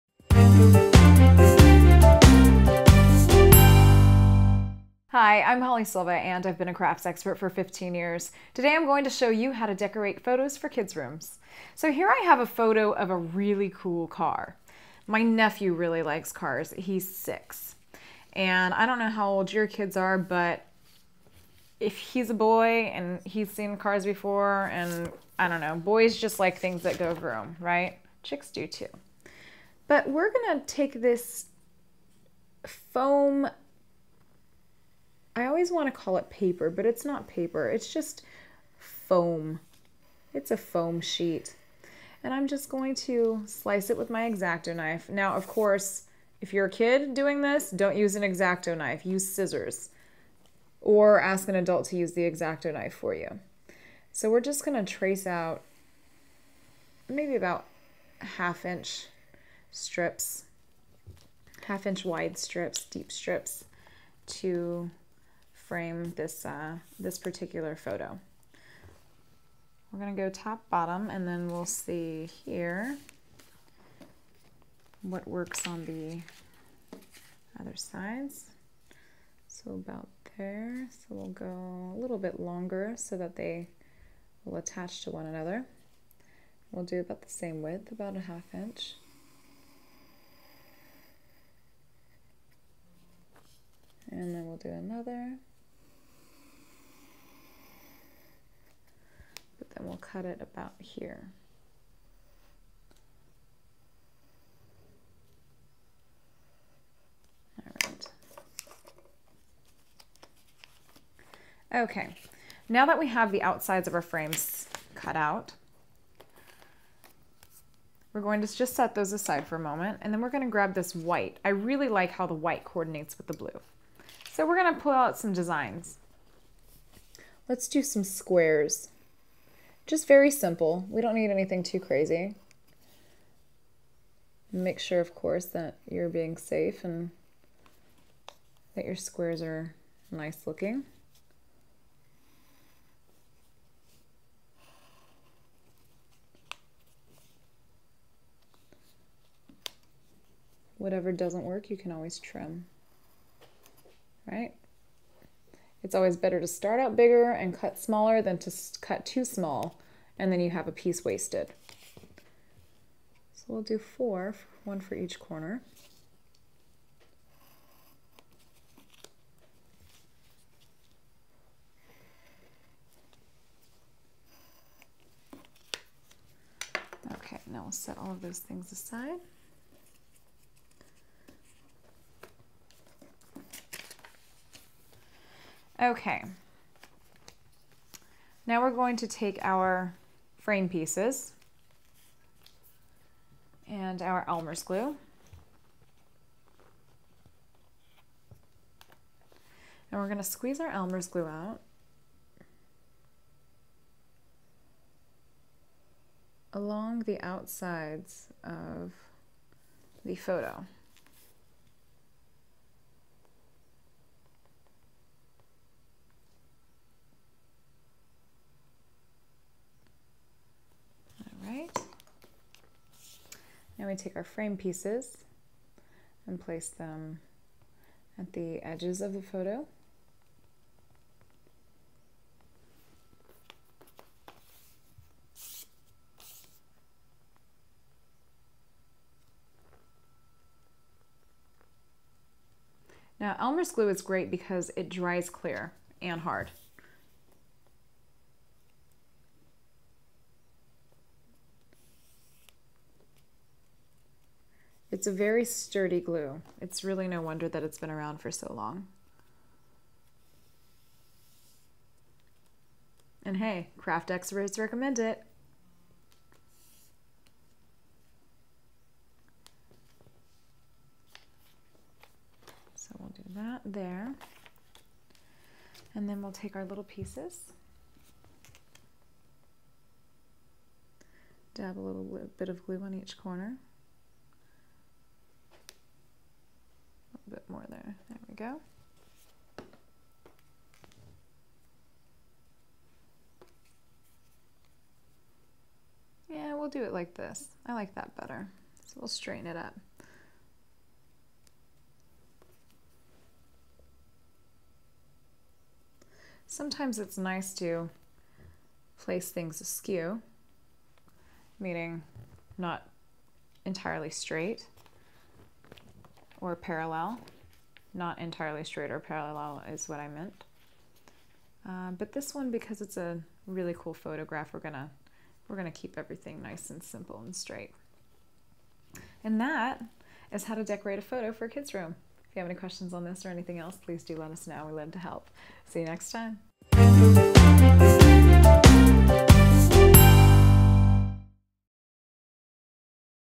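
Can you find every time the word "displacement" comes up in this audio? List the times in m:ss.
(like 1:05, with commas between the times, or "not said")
not said.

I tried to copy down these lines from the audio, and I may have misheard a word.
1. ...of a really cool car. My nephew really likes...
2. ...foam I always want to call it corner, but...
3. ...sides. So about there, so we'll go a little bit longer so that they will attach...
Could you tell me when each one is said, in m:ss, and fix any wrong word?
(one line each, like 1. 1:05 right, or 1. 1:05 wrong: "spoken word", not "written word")
1. 0:12 right
2. 0:32 wrong: "paper", not "corner"
3. 1:17 right.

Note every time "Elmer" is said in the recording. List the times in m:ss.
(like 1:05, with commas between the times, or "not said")
3:14, 3:20, 4:03.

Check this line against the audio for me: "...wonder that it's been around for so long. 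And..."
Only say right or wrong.
right.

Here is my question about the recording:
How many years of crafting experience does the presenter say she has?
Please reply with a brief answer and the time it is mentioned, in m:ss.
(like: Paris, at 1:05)
15, at 0:07.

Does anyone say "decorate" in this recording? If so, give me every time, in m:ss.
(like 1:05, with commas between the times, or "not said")
0:09, 5:30.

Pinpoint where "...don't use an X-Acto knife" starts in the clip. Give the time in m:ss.
0:47.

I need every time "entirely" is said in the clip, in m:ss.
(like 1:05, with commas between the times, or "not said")
5:13, 5:18.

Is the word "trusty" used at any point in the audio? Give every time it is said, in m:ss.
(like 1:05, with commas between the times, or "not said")
not said.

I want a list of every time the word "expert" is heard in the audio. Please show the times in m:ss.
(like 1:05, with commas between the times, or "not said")
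0:07, 4:24.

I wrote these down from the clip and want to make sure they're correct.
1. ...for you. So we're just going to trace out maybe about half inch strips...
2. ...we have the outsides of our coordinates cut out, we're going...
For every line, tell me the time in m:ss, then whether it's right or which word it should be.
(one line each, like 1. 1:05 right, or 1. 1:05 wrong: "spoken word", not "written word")
1. 0:52 right
2. 1:52 wrong: "frames", not "coordinates".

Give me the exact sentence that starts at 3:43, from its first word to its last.
we take our frame pieces and place them at the edges of the photo.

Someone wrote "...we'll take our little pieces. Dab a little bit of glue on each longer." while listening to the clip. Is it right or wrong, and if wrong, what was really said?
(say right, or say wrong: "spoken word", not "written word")
wrong: "corner", not "longer".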